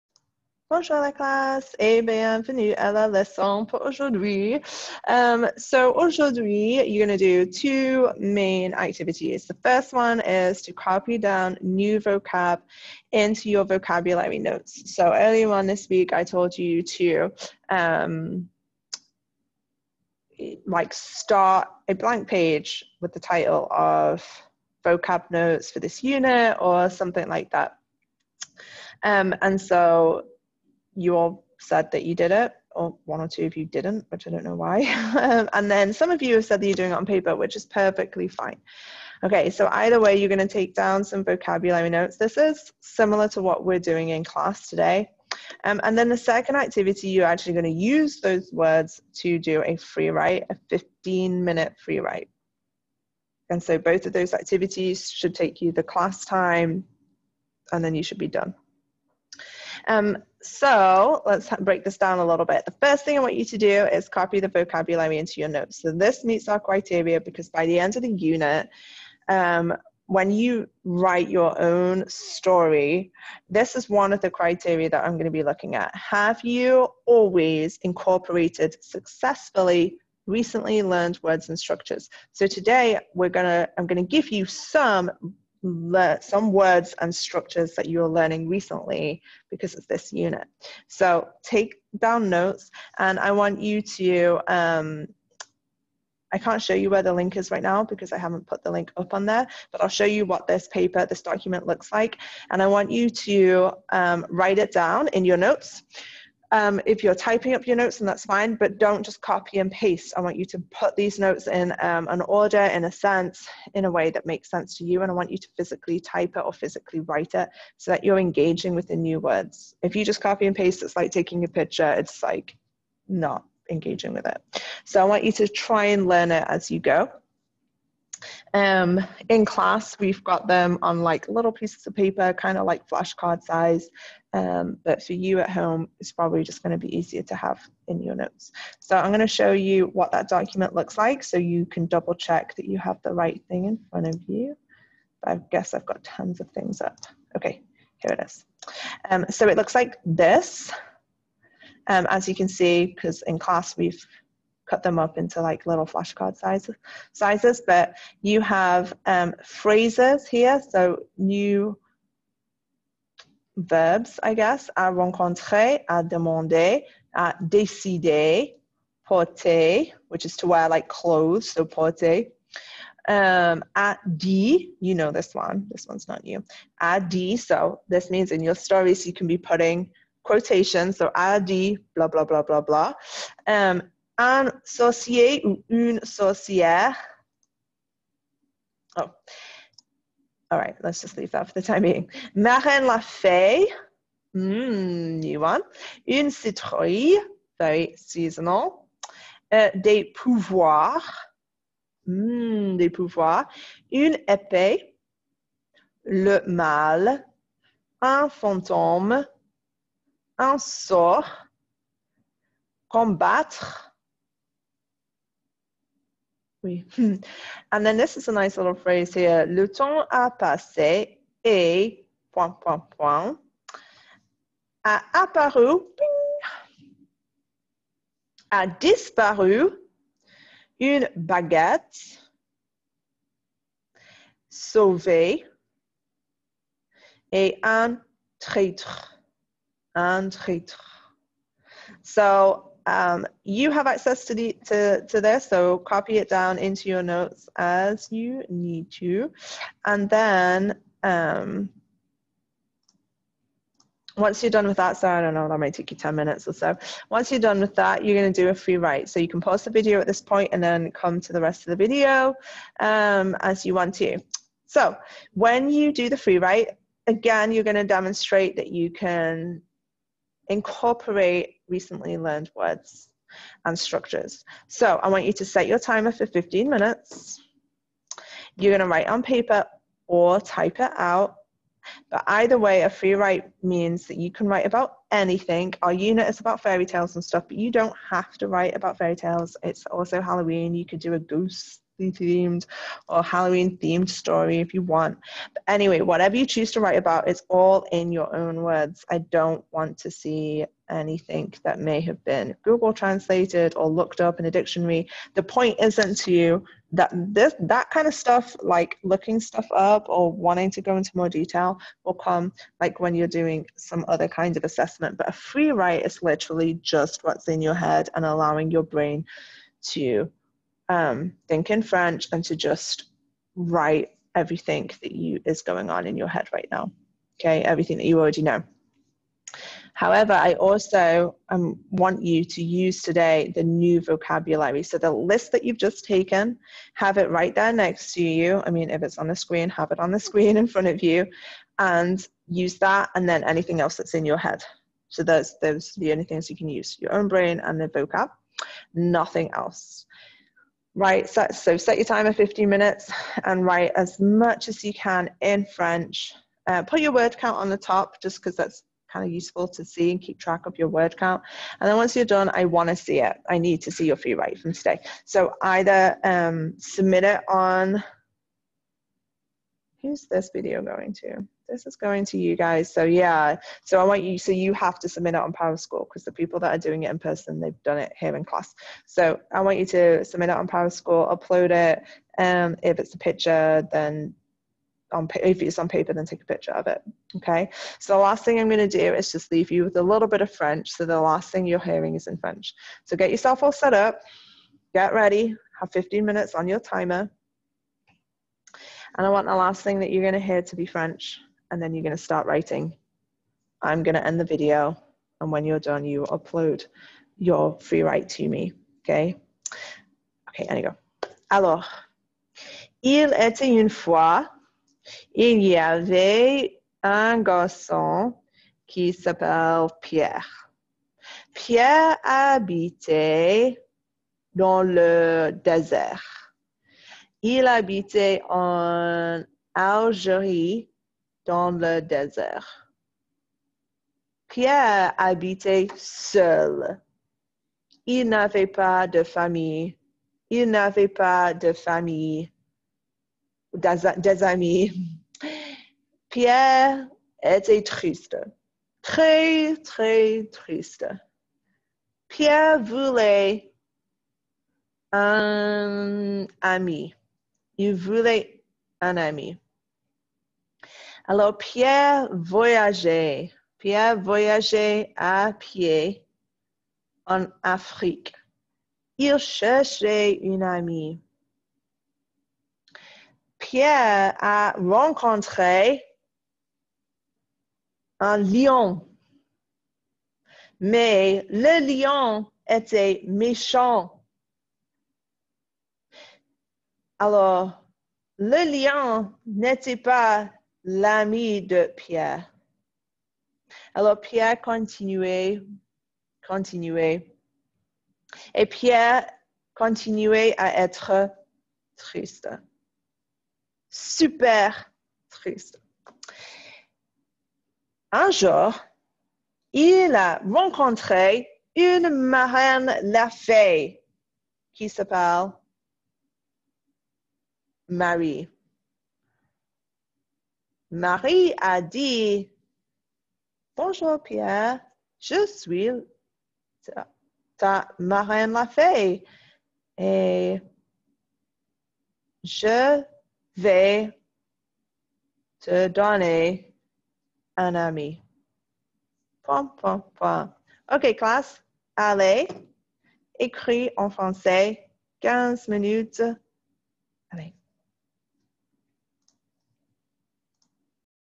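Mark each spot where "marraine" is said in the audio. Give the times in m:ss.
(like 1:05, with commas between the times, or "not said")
8:32, 8:47.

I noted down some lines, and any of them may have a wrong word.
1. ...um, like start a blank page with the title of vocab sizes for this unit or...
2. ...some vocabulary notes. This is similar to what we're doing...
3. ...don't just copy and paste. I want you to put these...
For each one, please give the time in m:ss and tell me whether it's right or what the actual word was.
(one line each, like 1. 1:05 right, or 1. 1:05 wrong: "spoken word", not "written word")
1. 0:17 wrong: "notes", not "sizes"
2. 0:41 right
3. 1:48 right.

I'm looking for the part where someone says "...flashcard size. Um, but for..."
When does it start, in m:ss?
2:12.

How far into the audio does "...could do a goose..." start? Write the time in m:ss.
4:50.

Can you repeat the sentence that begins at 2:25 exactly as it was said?
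I guess I've got tons of things up.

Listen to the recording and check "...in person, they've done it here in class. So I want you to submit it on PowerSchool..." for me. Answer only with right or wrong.
right.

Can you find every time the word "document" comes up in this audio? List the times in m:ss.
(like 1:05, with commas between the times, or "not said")
1:41, 2:20.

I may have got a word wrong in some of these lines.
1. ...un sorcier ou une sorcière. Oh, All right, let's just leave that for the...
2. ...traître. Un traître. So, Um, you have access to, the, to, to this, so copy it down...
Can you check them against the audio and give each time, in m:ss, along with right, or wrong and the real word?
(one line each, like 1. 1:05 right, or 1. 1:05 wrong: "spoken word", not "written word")
1. 3:04 right
2. 3:58 right.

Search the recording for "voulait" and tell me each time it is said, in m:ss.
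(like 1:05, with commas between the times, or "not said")
7:32, 7:37.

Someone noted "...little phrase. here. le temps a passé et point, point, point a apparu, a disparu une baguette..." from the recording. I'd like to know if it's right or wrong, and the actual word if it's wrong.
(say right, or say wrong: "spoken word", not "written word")
right.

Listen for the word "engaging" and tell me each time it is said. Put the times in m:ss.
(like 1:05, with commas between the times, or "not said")
1:58, 2:03.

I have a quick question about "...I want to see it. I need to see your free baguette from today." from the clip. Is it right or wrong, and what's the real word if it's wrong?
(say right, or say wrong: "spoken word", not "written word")
wrong: "write", not "baguette".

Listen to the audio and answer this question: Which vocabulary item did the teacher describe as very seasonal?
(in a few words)
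une citrouille.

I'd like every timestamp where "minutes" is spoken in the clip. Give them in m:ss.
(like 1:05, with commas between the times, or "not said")
0:51, 4:16, 4:36, 5:52, 6:36, 9:05.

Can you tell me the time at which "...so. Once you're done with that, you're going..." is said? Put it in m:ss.
4:16.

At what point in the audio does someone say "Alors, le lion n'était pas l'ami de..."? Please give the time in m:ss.
8:07.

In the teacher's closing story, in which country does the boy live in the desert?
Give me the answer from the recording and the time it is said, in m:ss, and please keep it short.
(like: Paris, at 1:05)
Algérie, at 7:09.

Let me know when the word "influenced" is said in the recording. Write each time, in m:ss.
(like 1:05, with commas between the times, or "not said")
not said.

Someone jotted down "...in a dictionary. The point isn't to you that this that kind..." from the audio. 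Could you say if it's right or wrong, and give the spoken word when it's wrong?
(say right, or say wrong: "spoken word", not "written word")
right.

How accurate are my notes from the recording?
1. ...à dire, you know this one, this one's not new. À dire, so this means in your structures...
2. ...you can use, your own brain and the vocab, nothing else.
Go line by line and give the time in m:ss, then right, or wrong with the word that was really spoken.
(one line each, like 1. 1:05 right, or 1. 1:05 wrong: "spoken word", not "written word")
1. 2:53 wrong: "stories", not "structures"
2. 5:46 right.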